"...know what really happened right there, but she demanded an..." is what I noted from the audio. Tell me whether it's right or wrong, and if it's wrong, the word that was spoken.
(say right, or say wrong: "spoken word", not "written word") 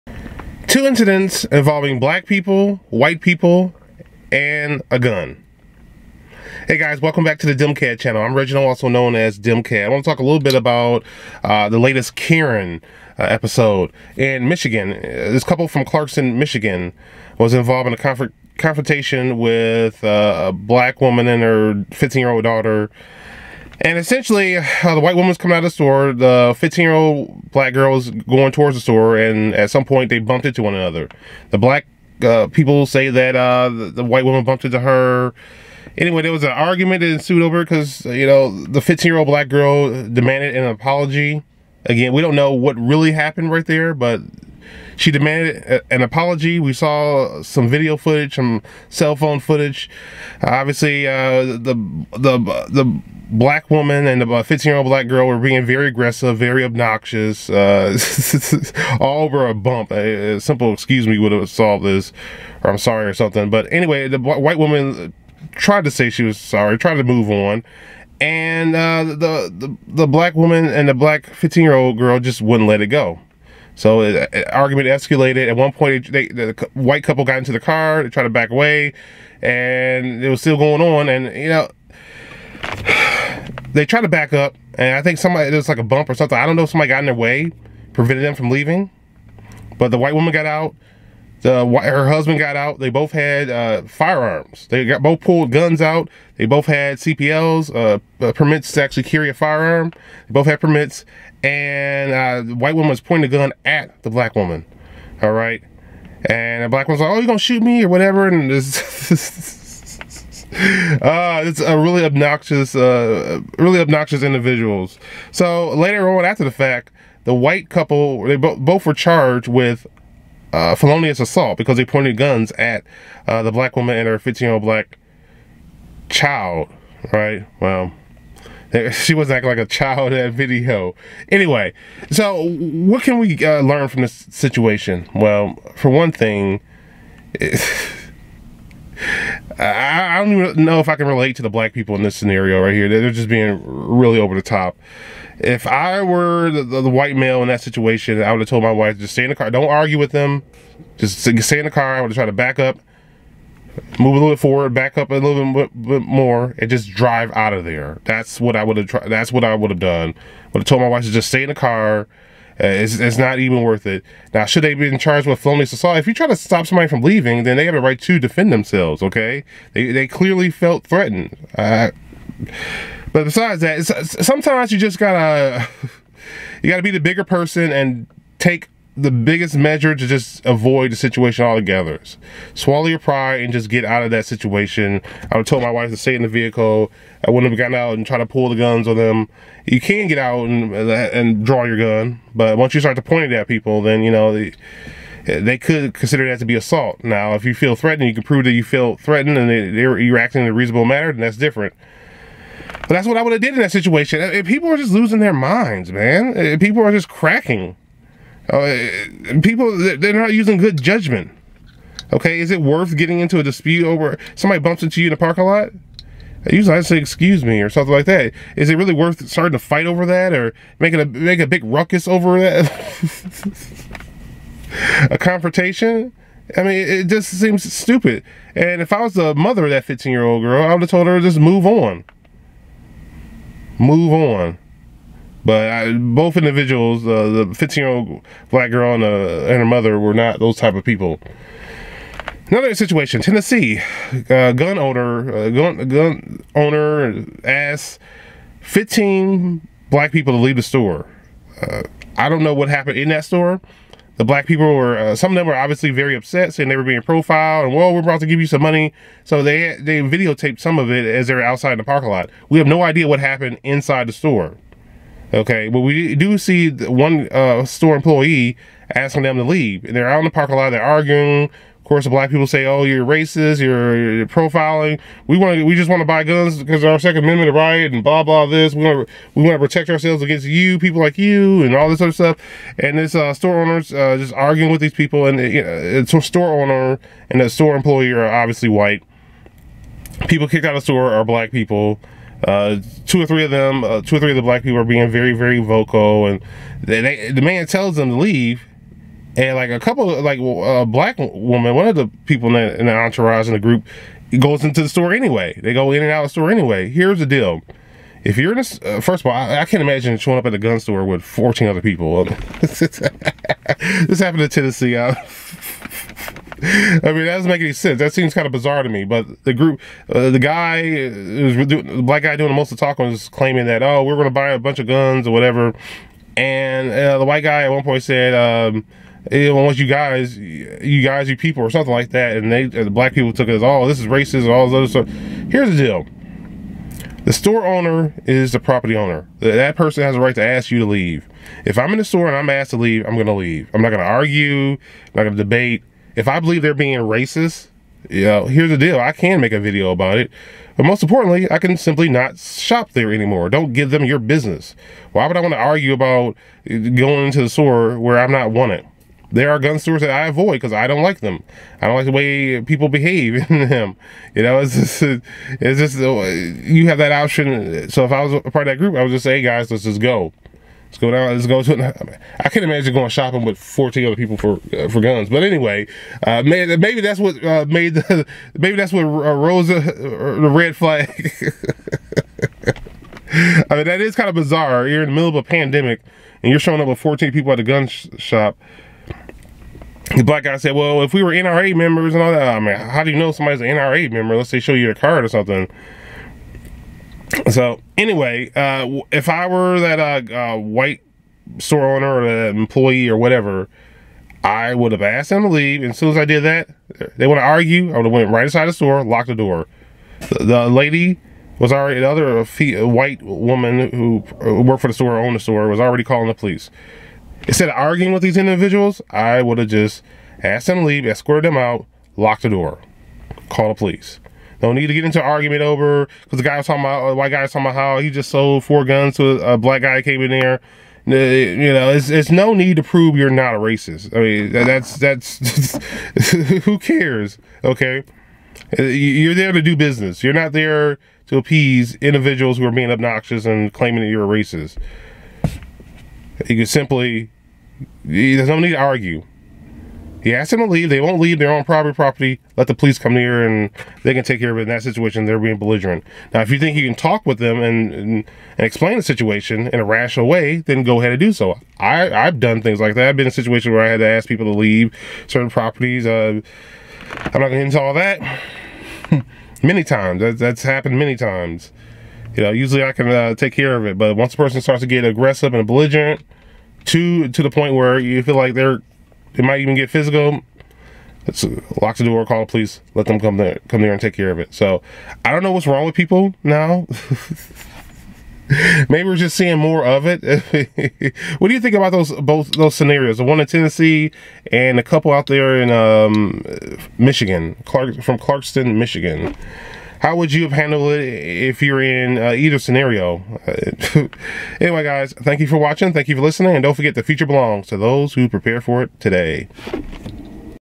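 right.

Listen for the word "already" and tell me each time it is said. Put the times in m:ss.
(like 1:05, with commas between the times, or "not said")
6:51, 6:55.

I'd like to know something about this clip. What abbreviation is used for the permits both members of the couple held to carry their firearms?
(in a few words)
CPLs.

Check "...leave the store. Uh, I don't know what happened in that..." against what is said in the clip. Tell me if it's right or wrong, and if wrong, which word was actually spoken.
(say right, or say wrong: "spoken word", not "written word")
right.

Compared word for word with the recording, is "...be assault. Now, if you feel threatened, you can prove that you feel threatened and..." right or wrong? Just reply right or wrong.
right.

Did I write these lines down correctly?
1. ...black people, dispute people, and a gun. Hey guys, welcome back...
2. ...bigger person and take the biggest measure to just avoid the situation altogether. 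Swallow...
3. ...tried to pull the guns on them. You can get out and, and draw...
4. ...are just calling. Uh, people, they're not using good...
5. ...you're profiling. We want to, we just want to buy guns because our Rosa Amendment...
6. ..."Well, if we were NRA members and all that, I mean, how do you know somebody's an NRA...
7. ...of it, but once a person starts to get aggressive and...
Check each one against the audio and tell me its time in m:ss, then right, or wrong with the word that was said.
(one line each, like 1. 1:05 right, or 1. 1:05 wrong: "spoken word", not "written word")
1. 0:01 wrong: "white", not "dispute"
2. 2:56 right
3. 3:08 right
4. 3:26 wrong: "cracking", not "calling"
5. 4:34 wrong: "Second", not "Rosa"
6. 6:30 right
7. 7:53 right.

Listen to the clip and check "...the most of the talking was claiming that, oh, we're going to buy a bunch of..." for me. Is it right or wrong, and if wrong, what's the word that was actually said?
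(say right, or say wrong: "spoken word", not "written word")
right.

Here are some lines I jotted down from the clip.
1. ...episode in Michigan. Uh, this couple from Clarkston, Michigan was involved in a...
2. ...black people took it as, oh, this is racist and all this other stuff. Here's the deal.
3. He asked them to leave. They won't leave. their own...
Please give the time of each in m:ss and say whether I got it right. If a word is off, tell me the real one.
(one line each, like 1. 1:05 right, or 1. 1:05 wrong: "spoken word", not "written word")
1. 0:13 right
2. 5:32 right
3. 7:30 right.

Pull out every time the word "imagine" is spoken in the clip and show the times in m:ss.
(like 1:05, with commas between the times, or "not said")
5:09, 6:12.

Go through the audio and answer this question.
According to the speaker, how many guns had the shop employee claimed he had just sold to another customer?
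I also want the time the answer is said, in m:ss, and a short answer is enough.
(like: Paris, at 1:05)
4, at 7:08.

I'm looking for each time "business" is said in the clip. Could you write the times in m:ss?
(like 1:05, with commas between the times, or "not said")
5:54, 7:19.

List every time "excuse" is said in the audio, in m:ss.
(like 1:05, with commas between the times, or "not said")
1:00, 3:36.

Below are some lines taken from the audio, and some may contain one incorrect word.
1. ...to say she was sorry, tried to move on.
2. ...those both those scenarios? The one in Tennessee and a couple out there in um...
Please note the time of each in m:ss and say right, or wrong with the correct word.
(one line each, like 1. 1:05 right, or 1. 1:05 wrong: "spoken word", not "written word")
1. 1:05 right
2. 8:11 right.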